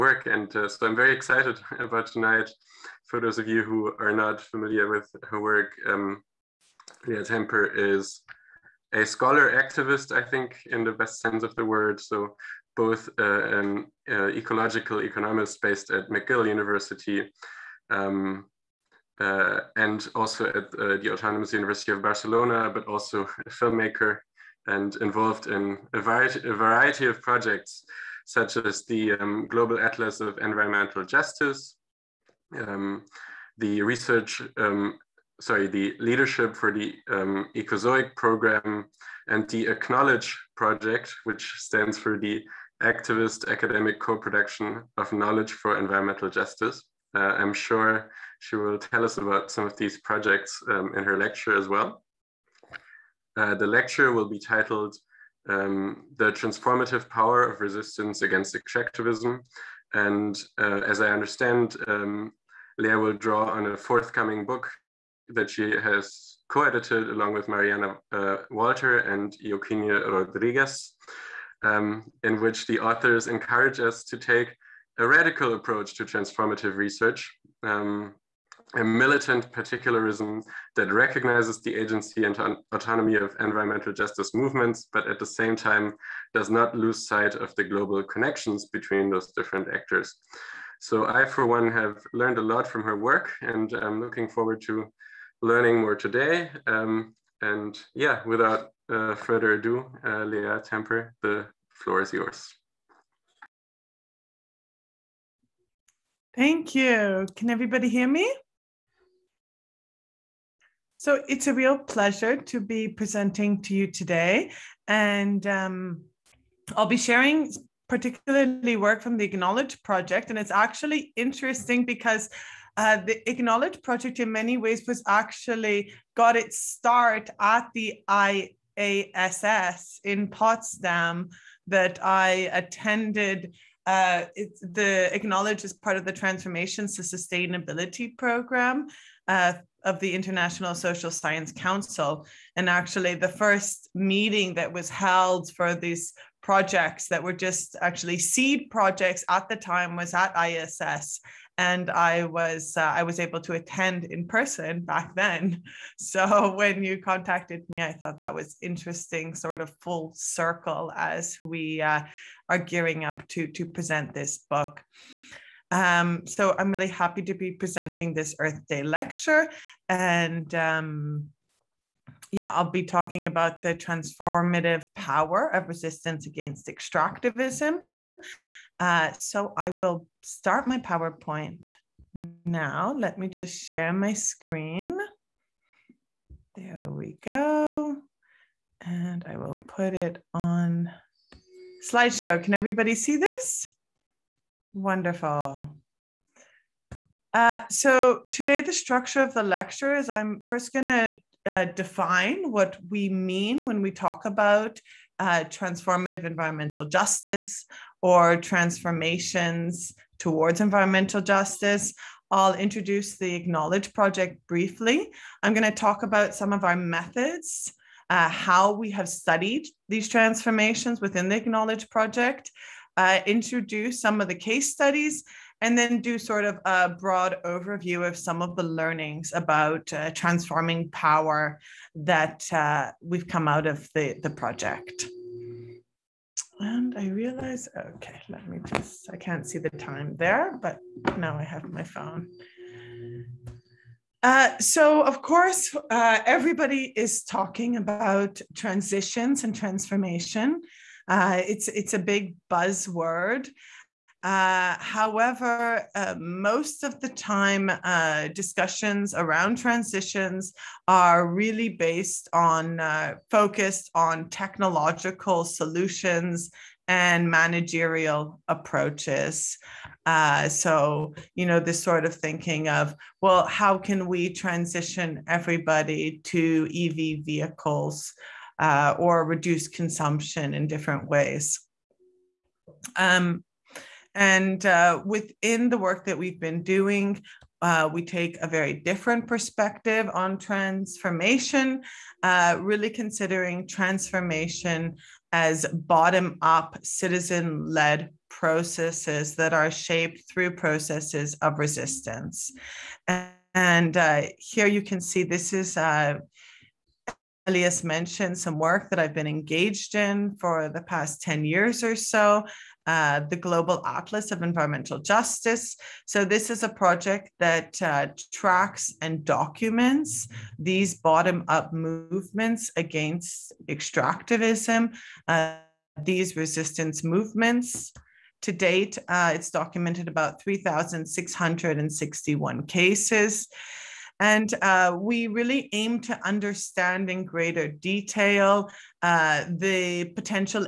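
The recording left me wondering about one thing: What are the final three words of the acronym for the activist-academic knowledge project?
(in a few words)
for Environmental Justice.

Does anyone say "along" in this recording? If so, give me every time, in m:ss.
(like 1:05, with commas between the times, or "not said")
1:07.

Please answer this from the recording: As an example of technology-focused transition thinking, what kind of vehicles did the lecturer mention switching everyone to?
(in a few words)
EV vehicles.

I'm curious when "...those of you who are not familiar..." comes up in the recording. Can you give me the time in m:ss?
0:03.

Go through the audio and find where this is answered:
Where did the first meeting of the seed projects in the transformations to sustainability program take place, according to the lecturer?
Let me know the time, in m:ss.
2:08.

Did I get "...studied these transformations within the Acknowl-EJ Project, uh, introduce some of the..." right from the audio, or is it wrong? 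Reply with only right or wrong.
right.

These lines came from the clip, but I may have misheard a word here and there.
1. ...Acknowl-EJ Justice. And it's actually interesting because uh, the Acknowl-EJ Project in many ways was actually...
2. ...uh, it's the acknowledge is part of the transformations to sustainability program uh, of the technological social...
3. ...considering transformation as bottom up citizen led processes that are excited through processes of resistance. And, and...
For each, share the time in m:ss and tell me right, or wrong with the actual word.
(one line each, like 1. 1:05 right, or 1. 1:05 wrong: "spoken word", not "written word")
1. 1:59 wrong: "Project", not "Justice"
2. 2:13 wrong: "international", not "technological"
3. 4:52 wrong: "shaped", not "excited".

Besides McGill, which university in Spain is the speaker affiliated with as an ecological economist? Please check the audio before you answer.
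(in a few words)
Autonomous University of Barcelona.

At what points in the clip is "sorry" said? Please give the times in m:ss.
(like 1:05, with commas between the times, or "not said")
0:35.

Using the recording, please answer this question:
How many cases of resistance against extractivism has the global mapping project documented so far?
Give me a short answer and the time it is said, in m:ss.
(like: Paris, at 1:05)
3,661, at 5:30.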